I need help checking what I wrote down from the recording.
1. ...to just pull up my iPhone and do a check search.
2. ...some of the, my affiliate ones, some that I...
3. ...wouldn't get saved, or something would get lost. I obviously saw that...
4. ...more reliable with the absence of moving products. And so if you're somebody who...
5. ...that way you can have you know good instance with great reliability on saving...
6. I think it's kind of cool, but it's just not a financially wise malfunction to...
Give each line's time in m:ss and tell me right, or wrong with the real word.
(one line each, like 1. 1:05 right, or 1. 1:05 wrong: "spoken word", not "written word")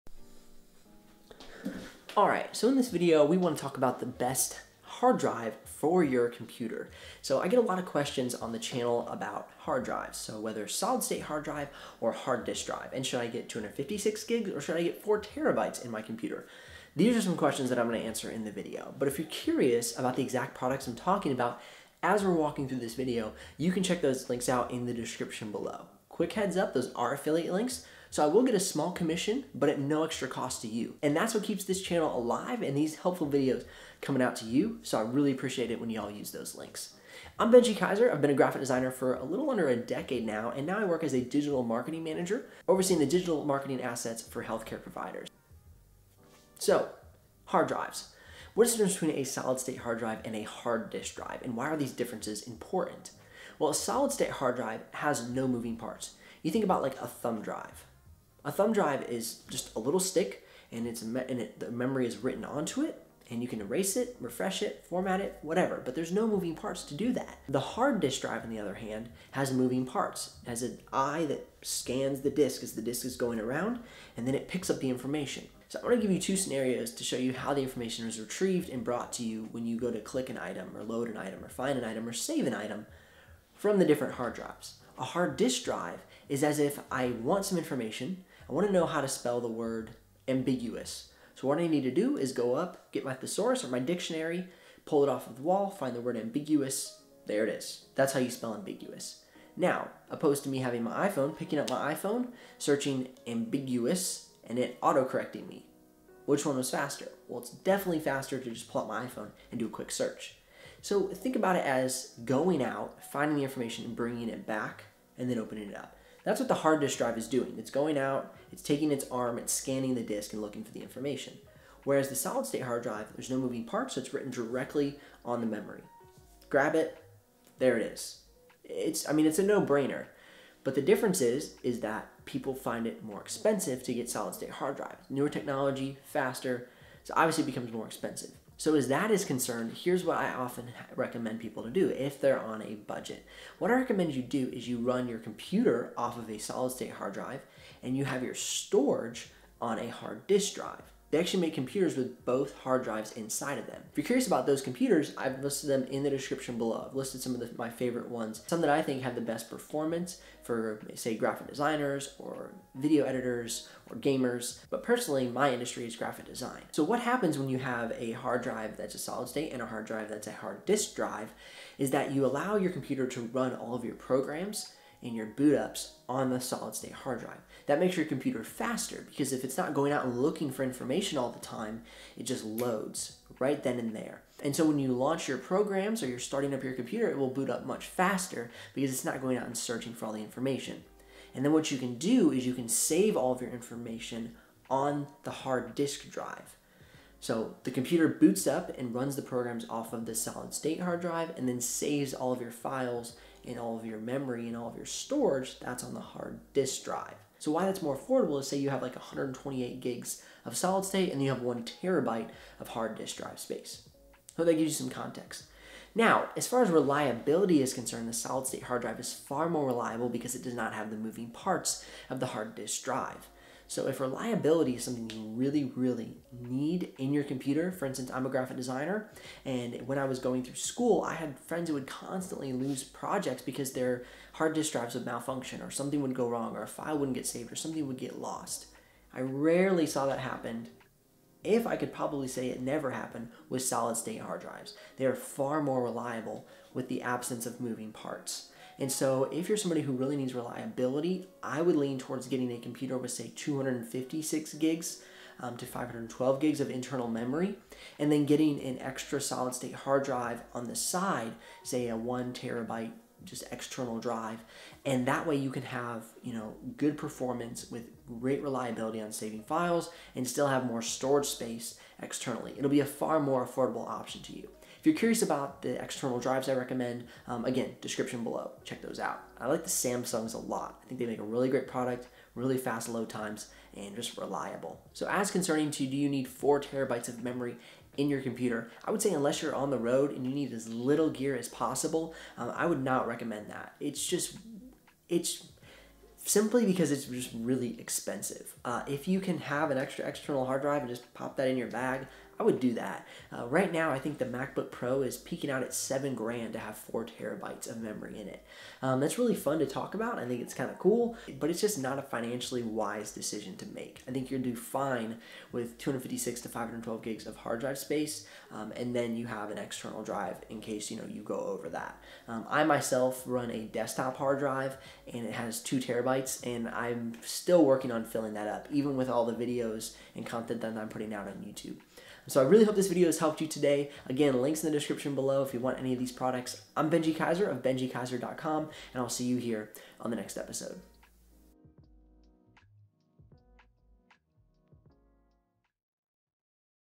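1. 1:48 wrong: "quick", not "check"
2. 2:37 wrong: "favorite", not "affiliate"
3. 3:56 wrong: "rarely", not "obviously"
4. 4:05 wrong: "parts", not "products"
5. 4:25 wrong: "performance", not "instance"
6. 5:10 wrong: "decision", not "malfunction".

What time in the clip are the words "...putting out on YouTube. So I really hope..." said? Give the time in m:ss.
5:30.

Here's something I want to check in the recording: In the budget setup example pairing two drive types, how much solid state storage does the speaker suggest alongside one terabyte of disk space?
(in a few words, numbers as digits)
128 gigs.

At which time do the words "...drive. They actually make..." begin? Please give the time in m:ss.
2:30.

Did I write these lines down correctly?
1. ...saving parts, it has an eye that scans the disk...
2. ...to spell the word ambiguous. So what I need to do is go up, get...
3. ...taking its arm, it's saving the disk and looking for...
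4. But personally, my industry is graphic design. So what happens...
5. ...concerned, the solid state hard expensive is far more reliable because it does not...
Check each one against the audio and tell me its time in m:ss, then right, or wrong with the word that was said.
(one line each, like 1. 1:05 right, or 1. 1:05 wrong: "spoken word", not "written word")
1. 1:09 wrong: "moving", not "saving"
2. 1:29 right
3. 1:58 wrong: "scanning", not "saving"
4. 2:44 right
5. 3:37 wrong: "drive", not "expensive".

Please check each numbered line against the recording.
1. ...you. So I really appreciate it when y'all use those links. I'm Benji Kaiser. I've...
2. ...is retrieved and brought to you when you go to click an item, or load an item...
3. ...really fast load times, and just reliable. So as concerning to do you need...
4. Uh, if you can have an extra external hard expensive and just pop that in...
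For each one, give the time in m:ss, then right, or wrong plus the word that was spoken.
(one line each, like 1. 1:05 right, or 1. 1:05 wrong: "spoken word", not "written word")
1. 0:34 right
2. 1:18 right
3. 4:42 right
4. 4:58 wrong: "drive", not "expensive".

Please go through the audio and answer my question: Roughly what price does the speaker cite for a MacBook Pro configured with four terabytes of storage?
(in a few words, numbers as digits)
7 grand.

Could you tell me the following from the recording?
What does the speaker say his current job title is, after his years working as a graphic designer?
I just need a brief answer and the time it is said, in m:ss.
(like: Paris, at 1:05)
digital marketing manager, at 0:41.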